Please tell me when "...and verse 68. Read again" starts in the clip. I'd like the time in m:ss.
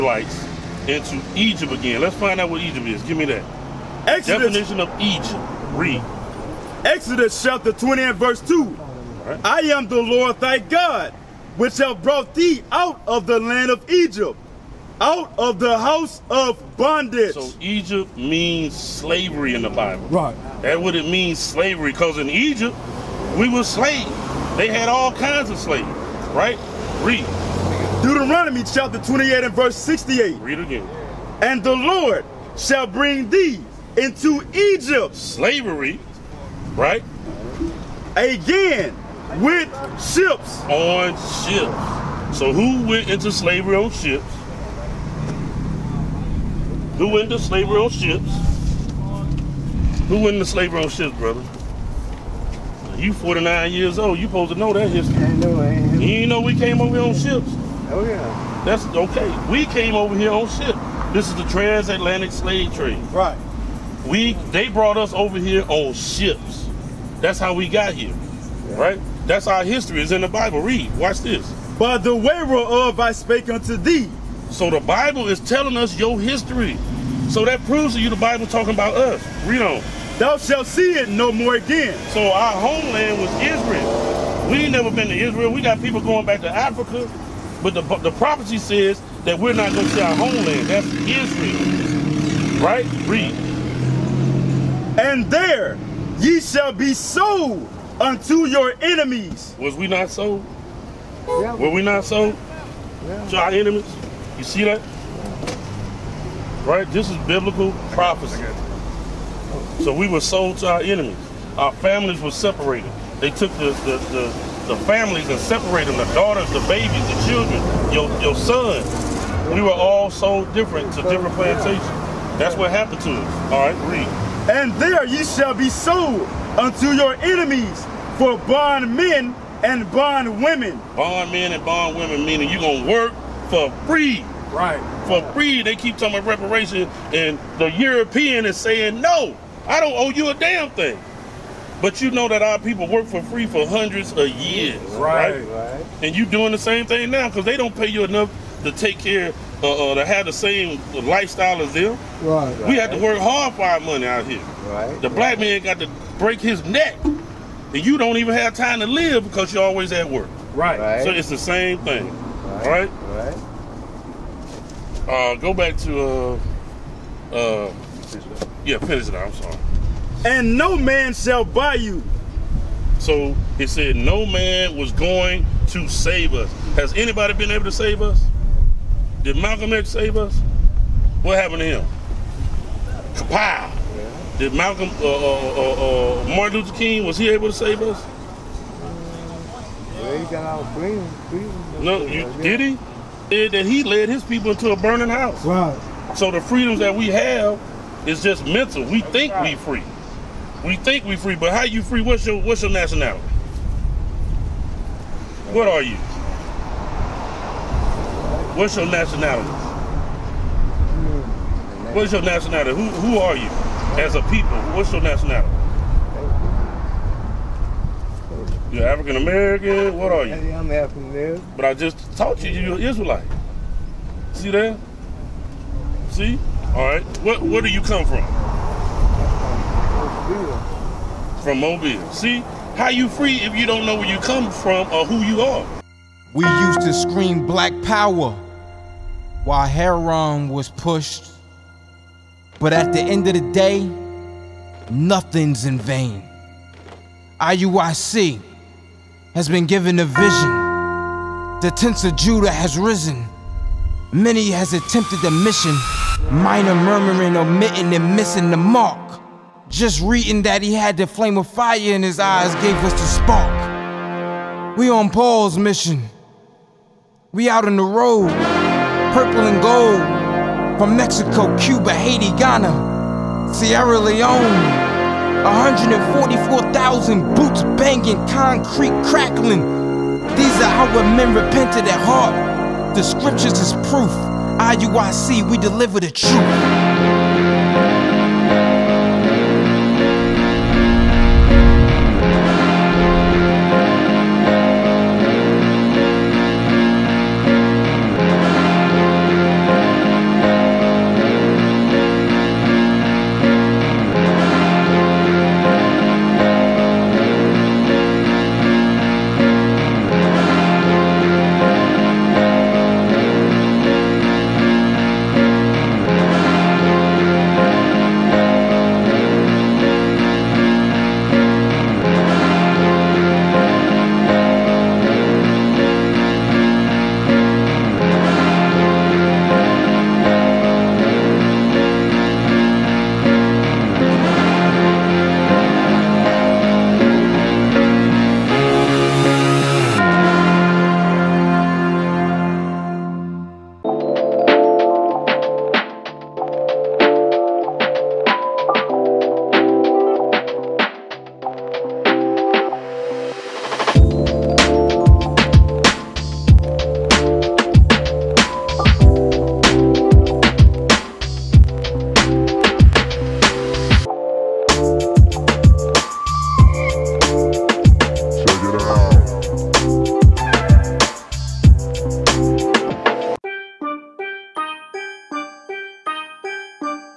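0:29.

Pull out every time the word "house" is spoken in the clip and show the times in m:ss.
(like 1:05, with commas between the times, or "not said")
0:15, 3:15.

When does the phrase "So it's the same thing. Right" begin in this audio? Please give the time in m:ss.
2:41.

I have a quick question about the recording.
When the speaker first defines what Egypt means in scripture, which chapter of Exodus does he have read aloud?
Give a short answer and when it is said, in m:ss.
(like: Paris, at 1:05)
Chapter 20, at 0:07.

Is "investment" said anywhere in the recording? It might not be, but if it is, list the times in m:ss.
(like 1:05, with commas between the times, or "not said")
not said.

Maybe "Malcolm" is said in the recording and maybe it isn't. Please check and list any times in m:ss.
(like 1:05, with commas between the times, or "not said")
2:59, 3:04.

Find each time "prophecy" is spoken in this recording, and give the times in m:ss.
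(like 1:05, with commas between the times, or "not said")
1:28, 1:47.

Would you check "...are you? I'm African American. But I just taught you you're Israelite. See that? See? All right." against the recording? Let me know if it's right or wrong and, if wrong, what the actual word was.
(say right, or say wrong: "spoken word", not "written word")
right.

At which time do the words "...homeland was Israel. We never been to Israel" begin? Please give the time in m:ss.
1:22.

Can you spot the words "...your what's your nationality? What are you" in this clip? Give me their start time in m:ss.
3:22.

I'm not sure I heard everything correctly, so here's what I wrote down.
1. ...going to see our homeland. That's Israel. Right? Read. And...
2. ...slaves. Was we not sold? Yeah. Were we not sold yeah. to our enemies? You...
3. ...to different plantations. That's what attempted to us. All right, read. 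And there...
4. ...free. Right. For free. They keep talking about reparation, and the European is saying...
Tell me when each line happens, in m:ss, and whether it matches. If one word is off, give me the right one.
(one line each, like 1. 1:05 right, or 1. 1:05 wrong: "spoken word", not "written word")
1. 1:29 right
2. 1:38 wrong: "enemies", not "slaves"
3. 2:00 wrong: "happened", not "attempted"
4. 2:13 right.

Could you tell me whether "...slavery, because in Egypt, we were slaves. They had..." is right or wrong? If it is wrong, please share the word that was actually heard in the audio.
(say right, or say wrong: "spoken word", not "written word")
right.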